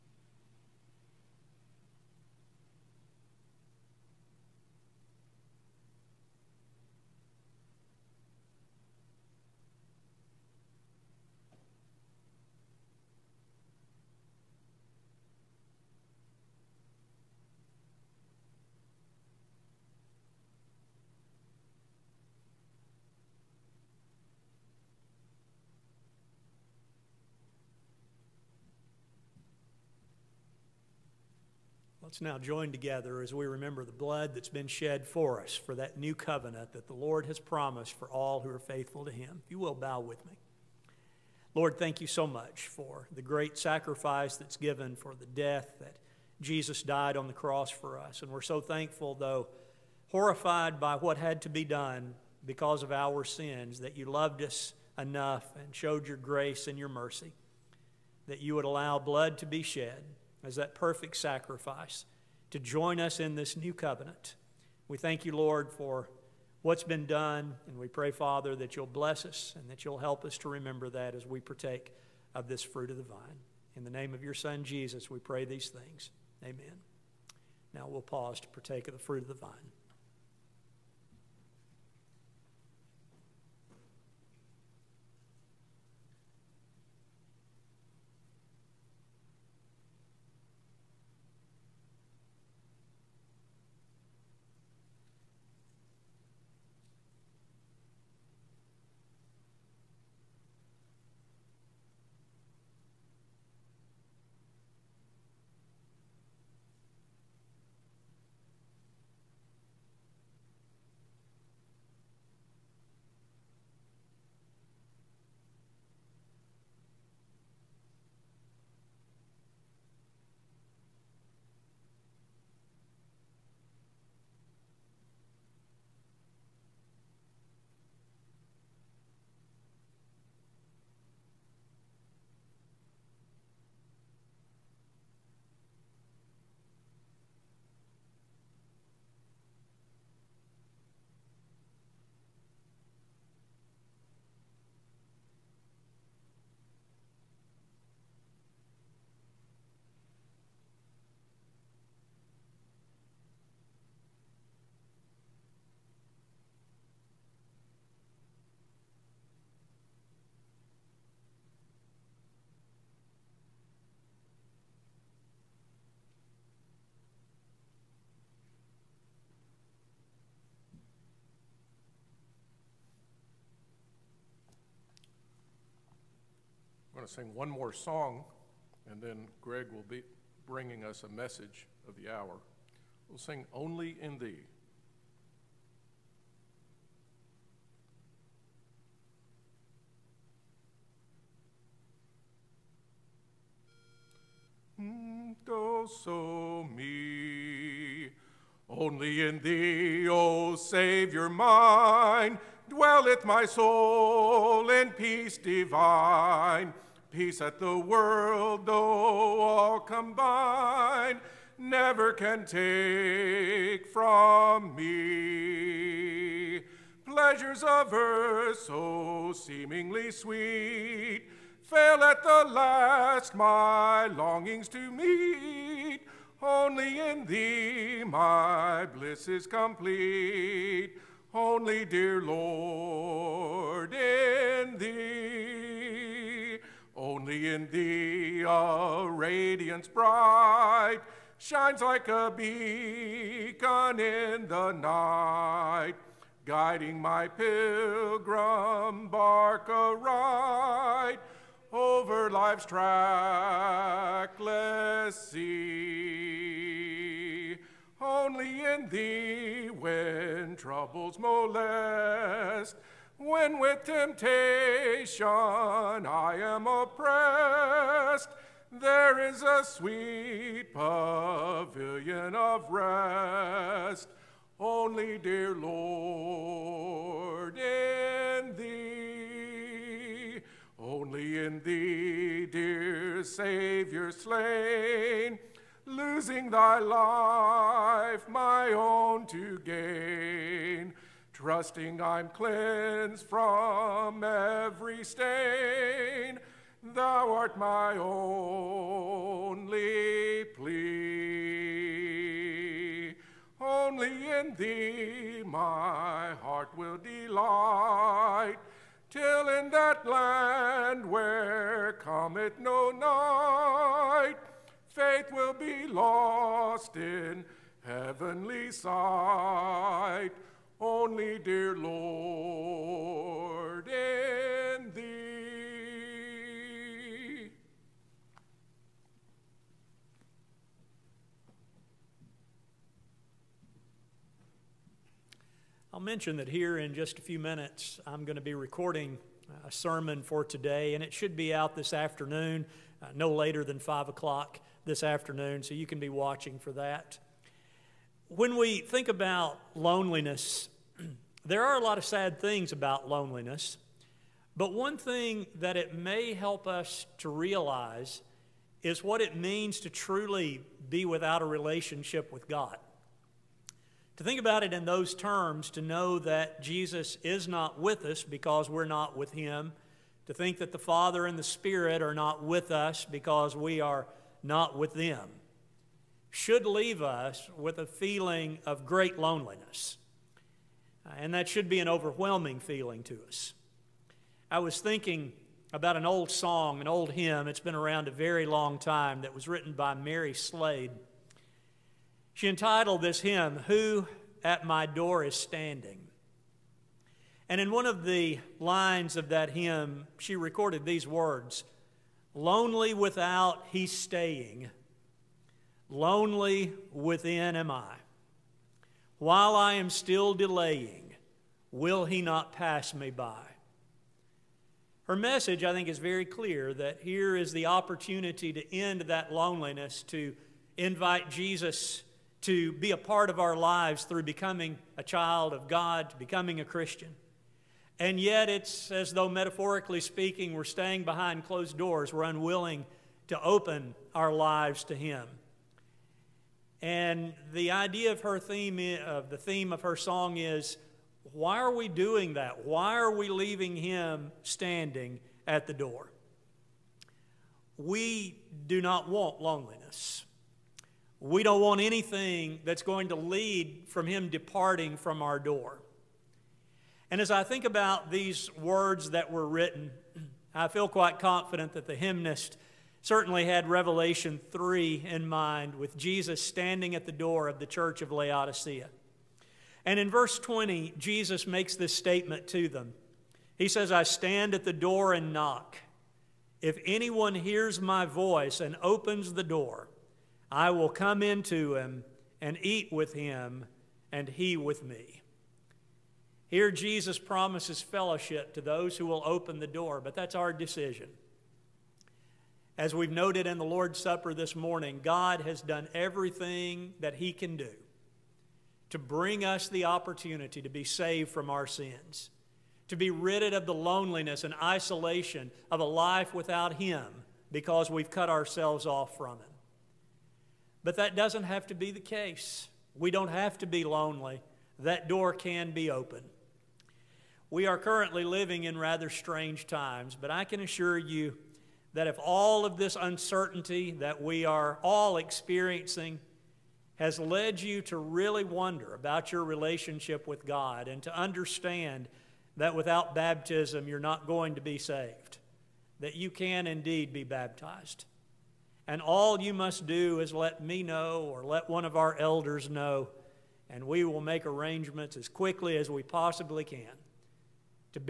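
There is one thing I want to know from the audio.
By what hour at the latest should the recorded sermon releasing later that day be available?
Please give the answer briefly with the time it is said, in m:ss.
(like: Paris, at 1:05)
5 o'clock, at 5:43.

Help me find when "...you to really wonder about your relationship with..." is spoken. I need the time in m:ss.
8:47.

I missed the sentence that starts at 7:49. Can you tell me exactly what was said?
And in verse 20, Jesus makes this statement to them.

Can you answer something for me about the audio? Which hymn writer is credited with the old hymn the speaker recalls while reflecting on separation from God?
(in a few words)
Mary Slade.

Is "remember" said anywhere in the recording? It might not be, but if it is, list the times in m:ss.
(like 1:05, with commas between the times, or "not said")
0:33, 1:10.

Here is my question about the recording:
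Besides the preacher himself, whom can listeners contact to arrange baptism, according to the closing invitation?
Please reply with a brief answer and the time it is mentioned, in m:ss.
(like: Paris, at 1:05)
one of our elders, at 9:01.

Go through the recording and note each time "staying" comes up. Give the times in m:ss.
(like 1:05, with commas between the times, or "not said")
6:43, 7:10.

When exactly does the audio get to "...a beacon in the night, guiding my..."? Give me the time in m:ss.
4:02.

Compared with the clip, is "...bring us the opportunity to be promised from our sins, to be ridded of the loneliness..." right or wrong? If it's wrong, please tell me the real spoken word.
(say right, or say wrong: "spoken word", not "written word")
wrong: "saved", not "promised".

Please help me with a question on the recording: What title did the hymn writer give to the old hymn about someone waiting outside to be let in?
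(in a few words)
Who at My Door Is Standing.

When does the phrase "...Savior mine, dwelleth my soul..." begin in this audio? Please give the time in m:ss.
3:20.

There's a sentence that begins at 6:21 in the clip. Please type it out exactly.
Uh, and that should be an overwhelming feeling to us.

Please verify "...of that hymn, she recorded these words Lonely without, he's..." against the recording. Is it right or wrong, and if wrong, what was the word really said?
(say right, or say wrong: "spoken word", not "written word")
right.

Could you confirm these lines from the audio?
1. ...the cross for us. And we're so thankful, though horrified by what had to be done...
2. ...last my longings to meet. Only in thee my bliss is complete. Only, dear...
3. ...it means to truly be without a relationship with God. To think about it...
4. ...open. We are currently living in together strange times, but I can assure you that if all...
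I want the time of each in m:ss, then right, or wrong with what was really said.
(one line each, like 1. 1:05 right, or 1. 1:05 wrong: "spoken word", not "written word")
1. 0:47 right
2. 3:42 right
3. 5:59 right
4. 8:35 wrong: "rather", not "together".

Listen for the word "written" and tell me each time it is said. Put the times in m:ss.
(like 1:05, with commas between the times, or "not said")
6:29, 7:39.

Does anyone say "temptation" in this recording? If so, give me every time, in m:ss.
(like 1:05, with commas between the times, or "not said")
4:23.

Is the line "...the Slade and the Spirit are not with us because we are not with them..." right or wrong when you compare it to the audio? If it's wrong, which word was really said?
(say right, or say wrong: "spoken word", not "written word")
wrong: "Father", not "Slade".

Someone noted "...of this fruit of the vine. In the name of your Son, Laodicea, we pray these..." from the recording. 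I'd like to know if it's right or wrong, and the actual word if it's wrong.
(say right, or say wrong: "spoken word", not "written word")
wrong: "Jesus", not "Laodicea".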